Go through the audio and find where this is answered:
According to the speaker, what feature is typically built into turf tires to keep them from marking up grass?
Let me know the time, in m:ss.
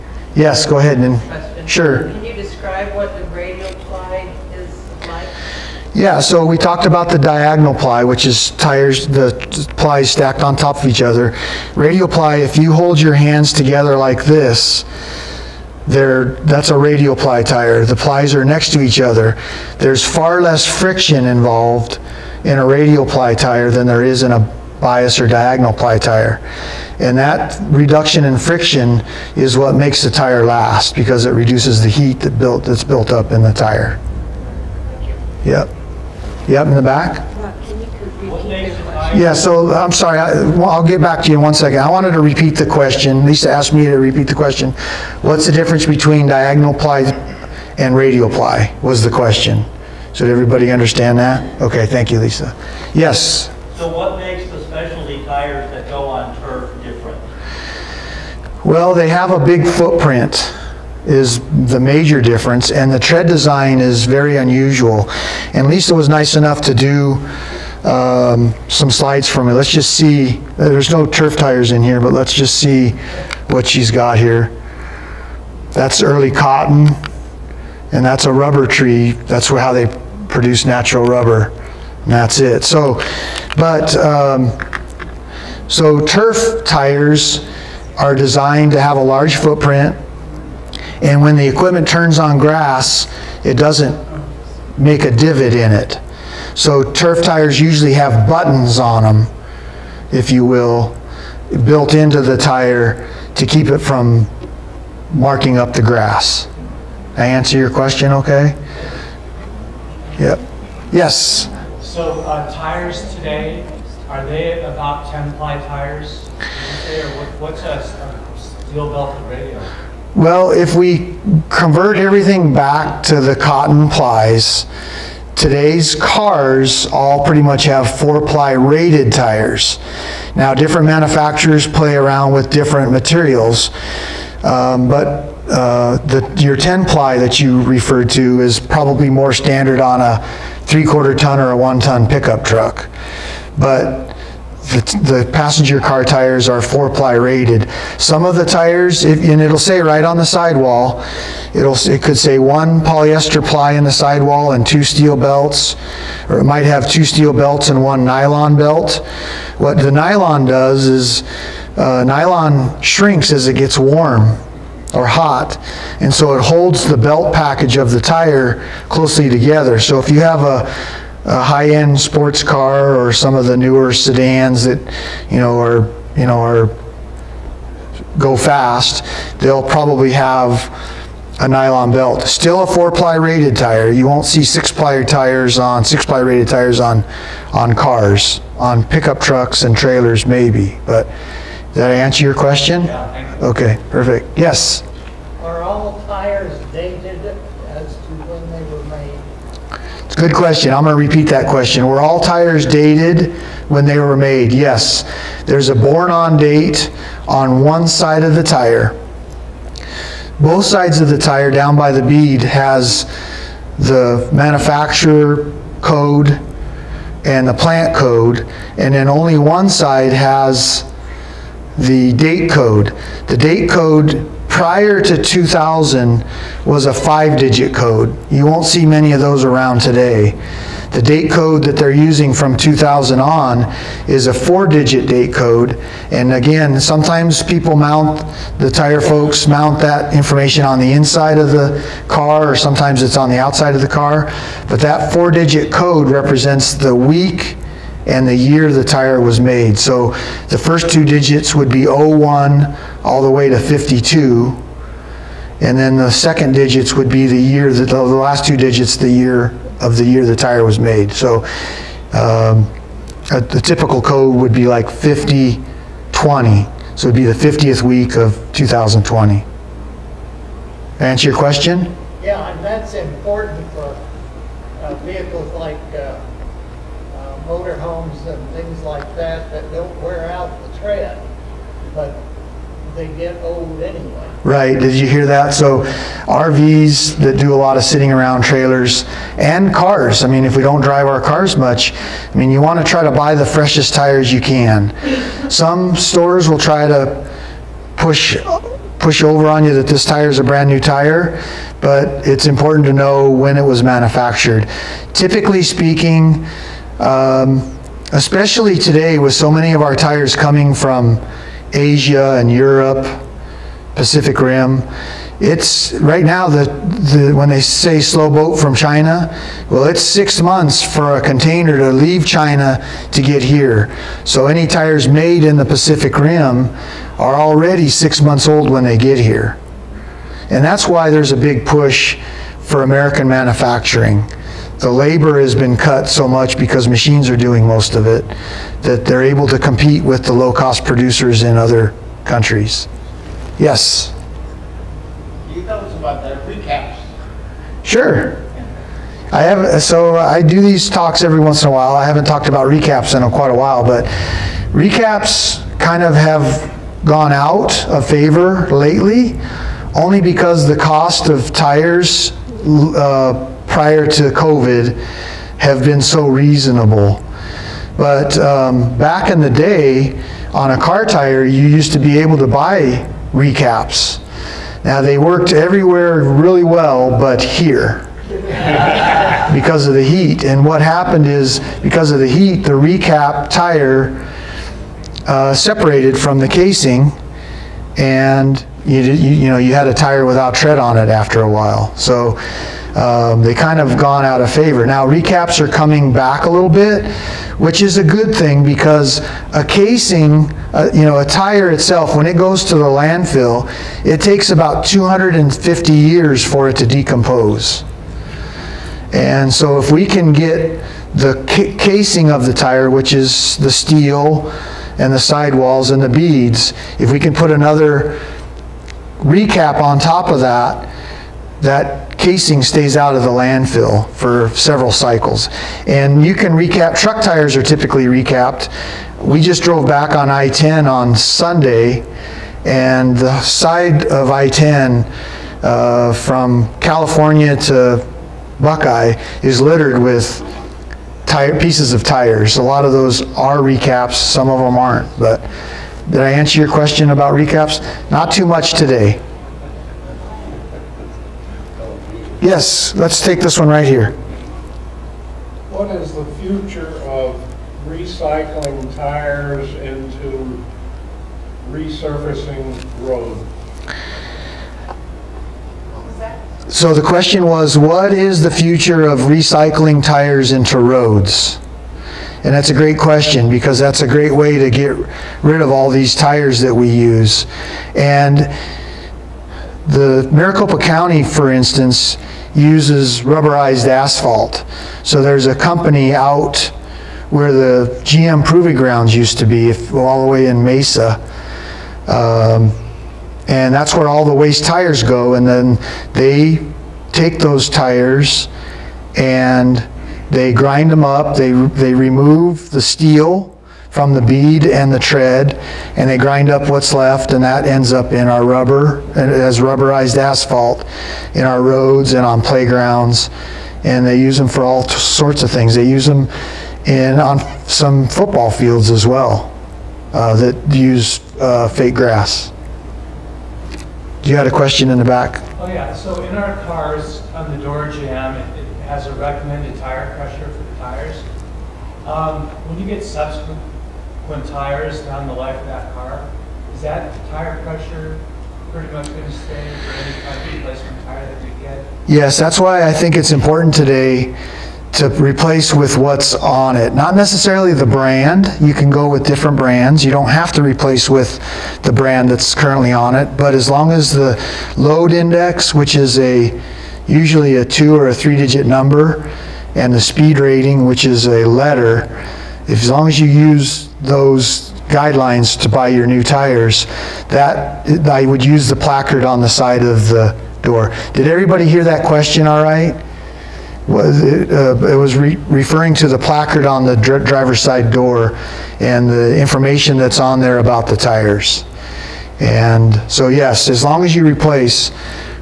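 1:38.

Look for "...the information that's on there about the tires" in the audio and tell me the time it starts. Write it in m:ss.
9:39.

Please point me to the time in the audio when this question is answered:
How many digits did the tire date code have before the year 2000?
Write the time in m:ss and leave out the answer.
3:46.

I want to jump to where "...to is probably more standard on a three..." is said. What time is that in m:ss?
2:18.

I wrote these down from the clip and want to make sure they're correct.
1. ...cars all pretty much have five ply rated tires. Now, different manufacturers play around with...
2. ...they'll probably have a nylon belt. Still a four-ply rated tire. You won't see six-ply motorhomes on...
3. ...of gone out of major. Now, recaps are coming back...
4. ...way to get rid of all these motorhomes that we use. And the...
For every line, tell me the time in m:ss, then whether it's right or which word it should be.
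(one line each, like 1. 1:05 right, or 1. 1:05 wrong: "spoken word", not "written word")
1. 2:05 wrong: "four", not "five"
2. 2:59 wrong: "tires", not "motorhomes"
3. 6:33 wrong: "favor", not "major"
4. 7:54 wrong: "tires", not "motorhomes".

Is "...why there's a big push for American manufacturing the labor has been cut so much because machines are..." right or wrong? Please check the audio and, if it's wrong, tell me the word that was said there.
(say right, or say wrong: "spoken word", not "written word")
right.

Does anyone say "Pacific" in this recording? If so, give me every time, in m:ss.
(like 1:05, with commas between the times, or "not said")
5:13, 5:25.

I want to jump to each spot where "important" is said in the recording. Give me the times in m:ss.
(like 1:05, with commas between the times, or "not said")
4:32, 5:02, 9:03.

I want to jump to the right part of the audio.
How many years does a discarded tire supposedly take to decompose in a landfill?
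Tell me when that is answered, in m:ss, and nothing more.
6:44.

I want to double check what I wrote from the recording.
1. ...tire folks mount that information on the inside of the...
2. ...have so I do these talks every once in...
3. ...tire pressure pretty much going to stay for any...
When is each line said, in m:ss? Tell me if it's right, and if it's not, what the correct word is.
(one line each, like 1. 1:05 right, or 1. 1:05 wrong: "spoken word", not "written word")
1. 3:58 right
2. 5:49 right
3. 8:57 right.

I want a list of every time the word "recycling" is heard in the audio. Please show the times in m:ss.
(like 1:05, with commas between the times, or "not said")
7:37, 7:49.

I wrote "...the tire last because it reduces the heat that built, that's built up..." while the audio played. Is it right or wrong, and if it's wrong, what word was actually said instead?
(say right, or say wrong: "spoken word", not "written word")
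right.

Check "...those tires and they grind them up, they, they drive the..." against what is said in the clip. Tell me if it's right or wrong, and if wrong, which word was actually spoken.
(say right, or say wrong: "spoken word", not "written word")
wrong: "remove", not "drive".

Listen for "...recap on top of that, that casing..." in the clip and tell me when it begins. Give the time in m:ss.
6:59.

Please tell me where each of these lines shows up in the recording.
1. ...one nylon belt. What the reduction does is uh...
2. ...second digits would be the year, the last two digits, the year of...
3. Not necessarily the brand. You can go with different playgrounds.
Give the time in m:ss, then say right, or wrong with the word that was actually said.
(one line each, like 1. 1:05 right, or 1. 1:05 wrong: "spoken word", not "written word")
1. 2:37 wrong: "nylon", not "reduction"
2. 4:16 right
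3. 9:06 wrong: "brands", not "playgrounds".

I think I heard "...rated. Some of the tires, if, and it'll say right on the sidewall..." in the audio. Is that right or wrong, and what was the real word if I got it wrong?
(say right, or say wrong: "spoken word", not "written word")
right.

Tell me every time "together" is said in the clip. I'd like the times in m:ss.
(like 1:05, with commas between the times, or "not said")
0:13, 2:49.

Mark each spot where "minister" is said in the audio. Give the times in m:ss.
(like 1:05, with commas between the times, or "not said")
not said.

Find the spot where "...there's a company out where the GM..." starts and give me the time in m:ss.
8:05.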